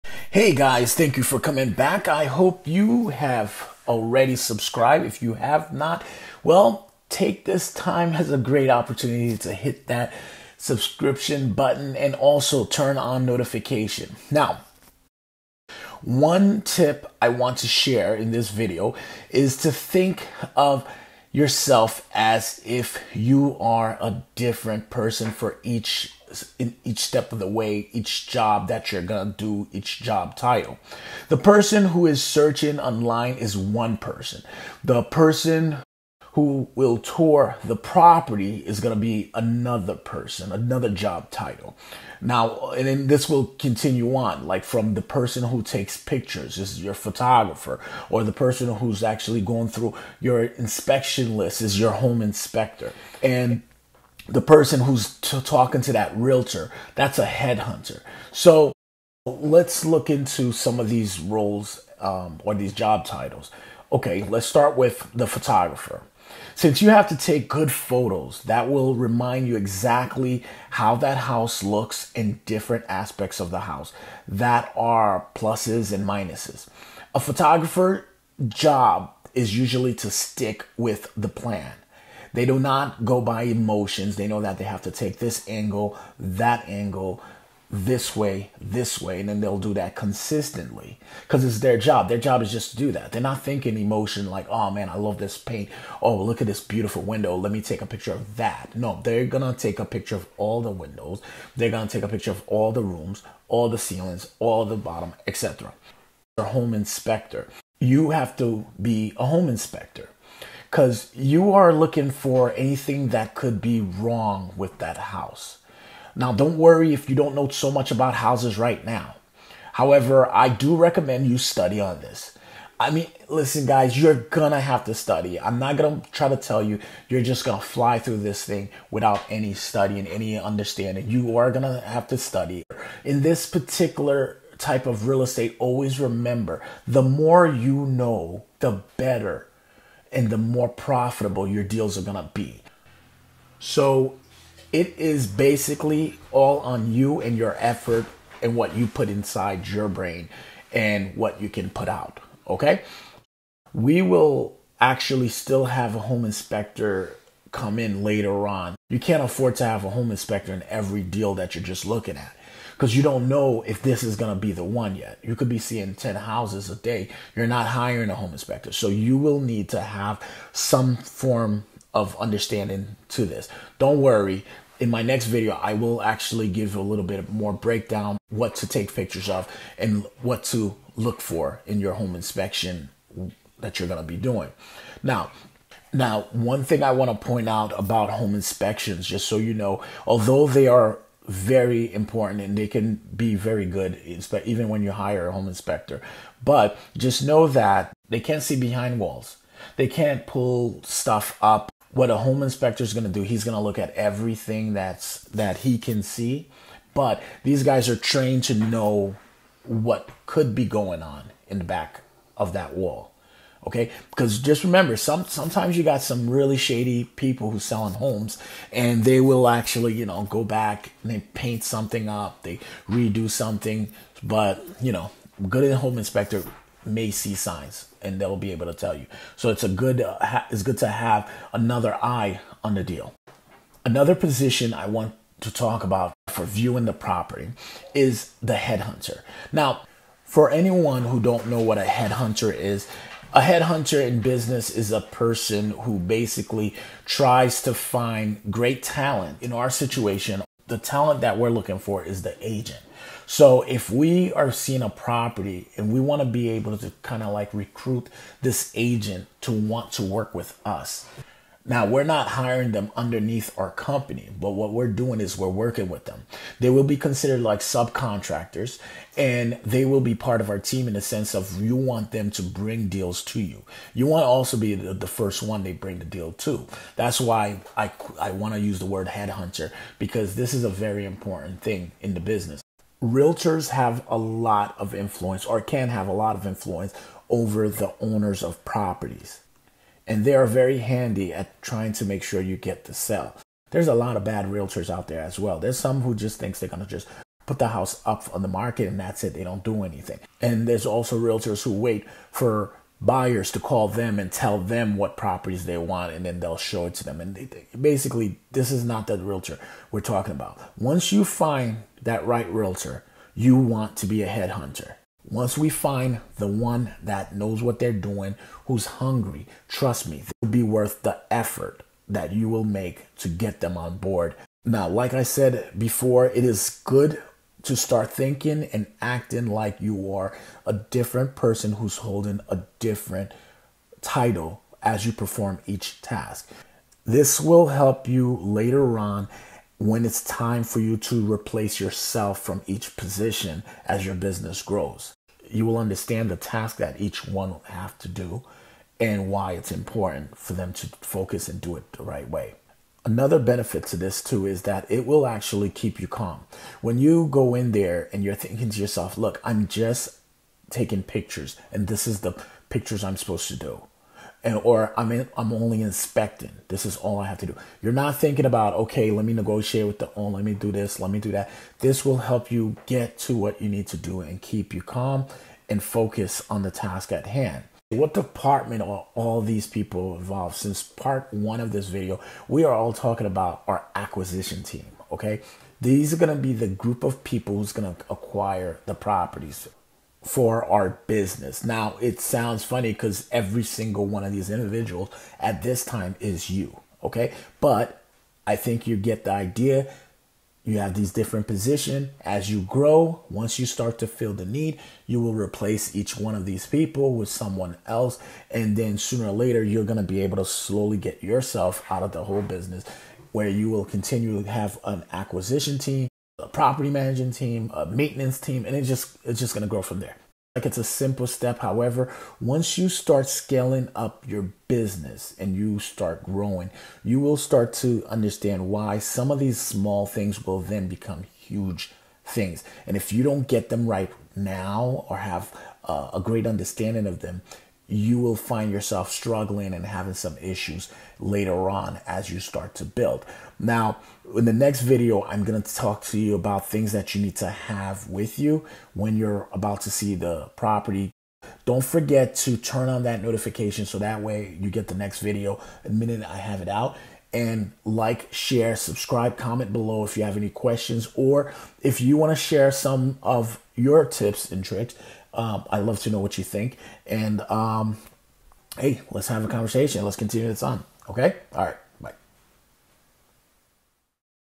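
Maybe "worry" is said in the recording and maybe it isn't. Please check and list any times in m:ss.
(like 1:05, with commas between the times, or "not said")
1:56, 2:54.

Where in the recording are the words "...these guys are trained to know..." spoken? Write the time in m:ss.
3:27.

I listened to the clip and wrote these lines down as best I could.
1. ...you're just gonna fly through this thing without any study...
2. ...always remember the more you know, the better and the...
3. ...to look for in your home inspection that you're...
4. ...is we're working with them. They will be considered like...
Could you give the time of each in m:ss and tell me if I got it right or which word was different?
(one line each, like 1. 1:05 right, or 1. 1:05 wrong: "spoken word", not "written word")
1. 2:07 right
2. 2:15 right
3. 3:00 right
4. 4:25 right.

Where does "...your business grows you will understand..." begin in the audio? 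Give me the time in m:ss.
5:44.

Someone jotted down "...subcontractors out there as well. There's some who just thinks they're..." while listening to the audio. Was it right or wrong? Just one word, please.
wrong.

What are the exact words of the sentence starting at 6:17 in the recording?
What department are all these people involved?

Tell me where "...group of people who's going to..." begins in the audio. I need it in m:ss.
6:26.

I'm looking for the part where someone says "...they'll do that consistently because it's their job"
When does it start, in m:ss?
1:29.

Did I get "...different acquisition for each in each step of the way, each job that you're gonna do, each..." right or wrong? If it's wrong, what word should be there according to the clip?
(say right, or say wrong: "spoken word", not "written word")
wrong: "person", not "acquisition".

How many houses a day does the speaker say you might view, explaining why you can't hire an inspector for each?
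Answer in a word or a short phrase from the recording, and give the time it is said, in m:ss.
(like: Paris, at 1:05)
10, at 2:45.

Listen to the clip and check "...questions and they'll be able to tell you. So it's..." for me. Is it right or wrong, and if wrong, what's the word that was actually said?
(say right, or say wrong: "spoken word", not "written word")
wrong: "signs", not "questions".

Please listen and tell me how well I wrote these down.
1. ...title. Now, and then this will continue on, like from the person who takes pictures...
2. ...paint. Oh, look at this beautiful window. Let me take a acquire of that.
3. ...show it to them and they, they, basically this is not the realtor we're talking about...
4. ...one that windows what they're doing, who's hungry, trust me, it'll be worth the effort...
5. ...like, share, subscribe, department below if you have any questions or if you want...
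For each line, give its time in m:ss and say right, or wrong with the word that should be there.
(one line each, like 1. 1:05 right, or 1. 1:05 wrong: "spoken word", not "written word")
1. 0:41 right
2. 1:35 wrong: "picture", not "acquire"
3. 5:06 right
4. 5:16 wrong: "knows", not "windows"
5. 7:37 wrong: "comment", not "department".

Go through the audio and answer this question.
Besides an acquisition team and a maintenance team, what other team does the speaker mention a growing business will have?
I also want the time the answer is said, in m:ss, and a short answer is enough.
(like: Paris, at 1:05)
property managing team, at 6:56.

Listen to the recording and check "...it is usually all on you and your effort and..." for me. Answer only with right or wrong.
wrong.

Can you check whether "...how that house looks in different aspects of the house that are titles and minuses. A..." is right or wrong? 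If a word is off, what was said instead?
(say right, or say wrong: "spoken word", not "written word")
wrong: "pluses", not "titles".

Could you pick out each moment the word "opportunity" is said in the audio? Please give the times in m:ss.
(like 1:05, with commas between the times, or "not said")
0:08.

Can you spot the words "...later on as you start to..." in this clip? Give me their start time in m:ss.
7:21.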